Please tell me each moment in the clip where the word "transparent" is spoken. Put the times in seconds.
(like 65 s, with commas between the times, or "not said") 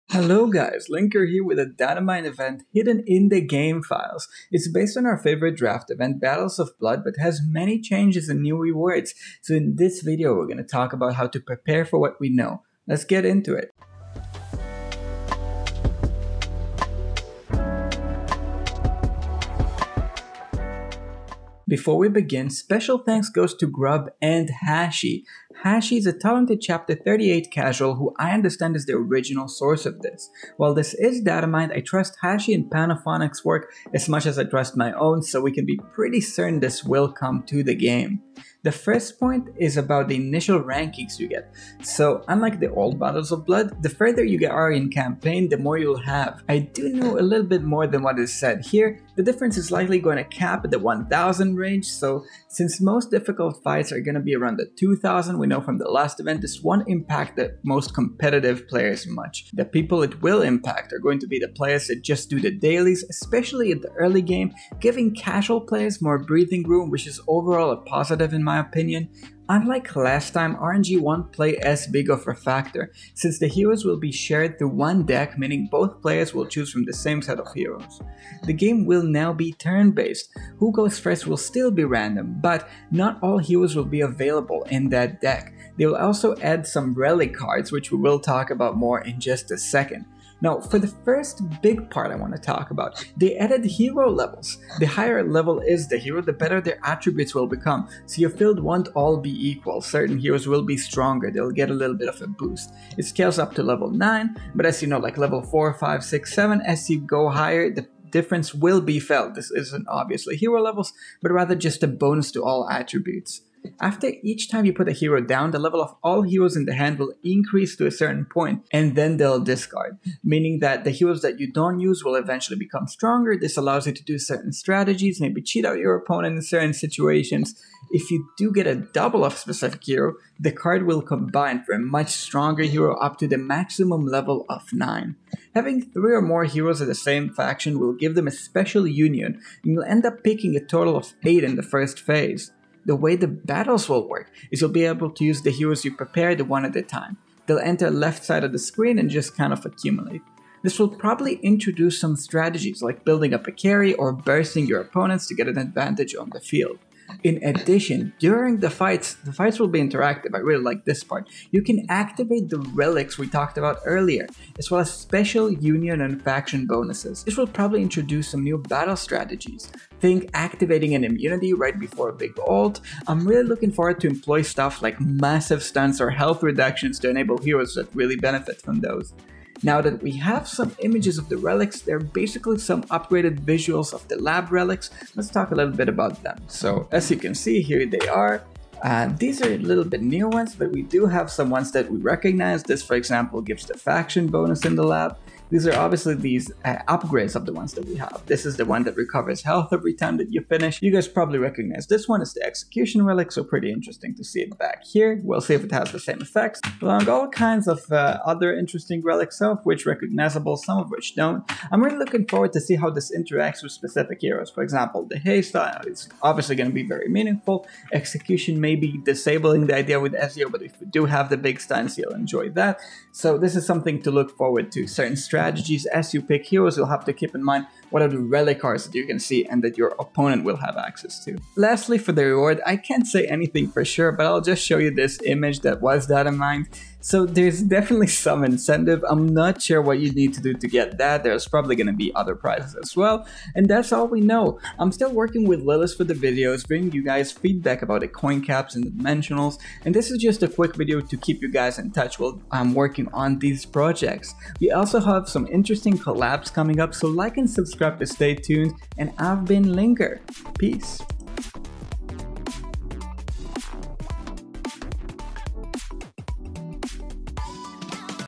not said.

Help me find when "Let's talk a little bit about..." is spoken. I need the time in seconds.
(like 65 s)
185 s.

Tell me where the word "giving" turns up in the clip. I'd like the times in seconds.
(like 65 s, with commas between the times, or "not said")
64 s.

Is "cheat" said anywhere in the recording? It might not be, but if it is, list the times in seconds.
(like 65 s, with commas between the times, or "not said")
125 s.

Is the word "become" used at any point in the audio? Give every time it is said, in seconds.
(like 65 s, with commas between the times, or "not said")
97 s, 122 s.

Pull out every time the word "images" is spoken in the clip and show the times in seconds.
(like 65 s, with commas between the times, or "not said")
180 s, 235 s.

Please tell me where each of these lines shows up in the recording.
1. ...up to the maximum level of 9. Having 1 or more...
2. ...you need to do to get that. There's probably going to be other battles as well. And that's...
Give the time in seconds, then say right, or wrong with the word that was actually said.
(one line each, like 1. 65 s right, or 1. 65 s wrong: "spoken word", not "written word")
1. 132 s wrong: "3", not "1"
2. 239 s wrong: "prizes", not "battles".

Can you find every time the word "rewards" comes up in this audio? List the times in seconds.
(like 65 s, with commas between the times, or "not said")
8 s, 232 s.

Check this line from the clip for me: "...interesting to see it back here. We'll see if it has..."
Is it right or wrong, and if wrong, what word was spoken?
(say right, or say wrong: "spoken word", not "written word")
right.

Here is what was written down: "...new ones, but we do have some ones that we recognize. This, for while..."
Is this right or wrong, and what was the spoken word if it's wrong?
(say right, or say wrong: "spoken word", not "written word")
wrong: "example", not "while".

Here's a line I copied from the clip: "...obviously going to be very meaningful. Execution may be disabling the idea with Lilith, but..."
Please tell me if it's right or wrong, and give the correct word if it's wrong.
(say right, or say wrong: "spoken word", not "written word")
wrong: "Ezio", not "Lilith".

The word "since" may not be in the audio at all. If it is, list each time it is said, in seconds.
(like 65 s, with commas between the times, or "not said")
52 s, 73 s.